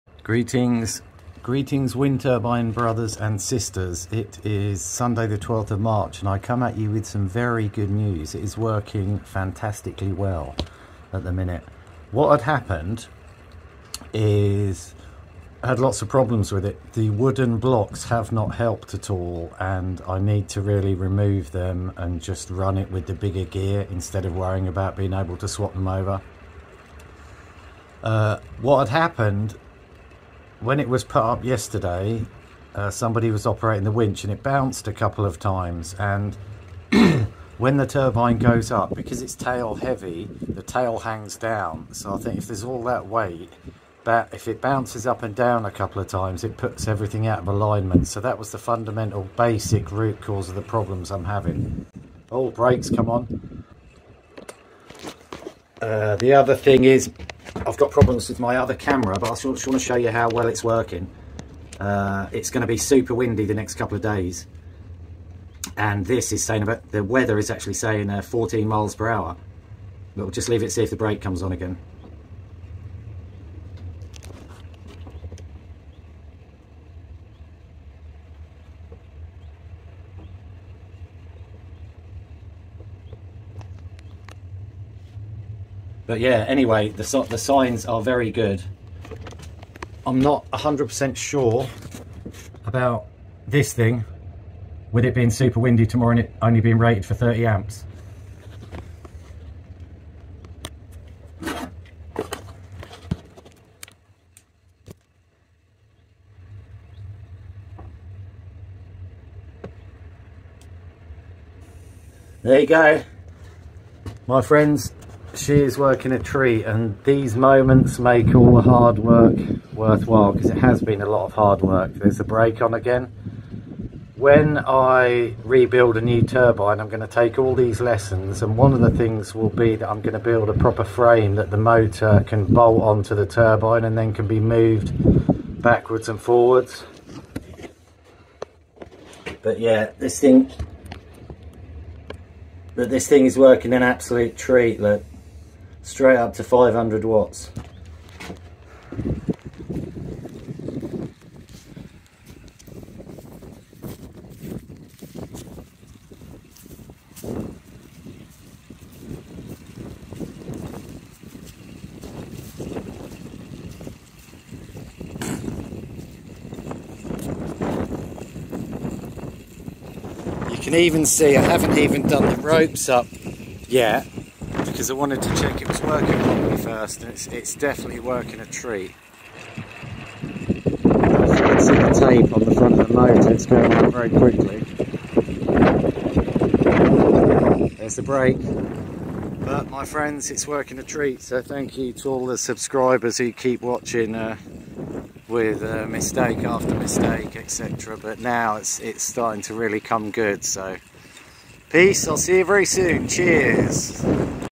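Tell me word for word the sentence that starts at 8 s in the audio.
It is working fantastically well at the minute.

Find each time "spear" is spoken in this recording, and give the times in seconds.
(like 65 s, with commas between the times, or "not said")
not said.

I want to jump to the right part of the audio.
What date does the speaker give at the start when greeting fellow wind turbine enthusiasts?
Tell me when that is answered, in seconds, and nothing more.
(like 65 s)
4 s.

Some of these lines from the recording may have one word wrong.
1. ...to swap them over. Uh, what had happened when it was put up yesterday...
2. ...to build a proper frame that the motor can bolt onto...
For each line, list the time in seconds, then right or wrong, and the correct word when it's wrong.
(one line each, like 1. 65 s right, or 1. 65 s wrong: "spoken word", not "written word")
1. 25 s right
2. 130 s right.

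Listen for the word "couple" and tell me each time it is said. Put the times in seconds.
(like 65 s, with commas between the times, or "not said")
34 s, 45 s, 63 s.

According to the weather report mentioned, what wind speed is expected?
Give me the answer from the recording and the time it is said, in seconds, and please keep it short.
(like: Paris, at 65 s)
14 mph, at 68 s.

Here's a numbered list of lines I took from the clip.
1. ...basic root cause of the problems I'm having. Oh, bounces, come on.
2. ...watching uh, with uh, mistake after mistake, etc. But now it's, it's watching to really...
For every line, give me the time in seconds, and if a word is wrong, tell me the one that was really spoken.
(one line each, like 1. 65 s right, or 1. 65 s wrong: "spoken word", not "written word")
1. 49 s wrong: "brakes", not "bounces"
2. 193 s wrong: "starting", not "watching".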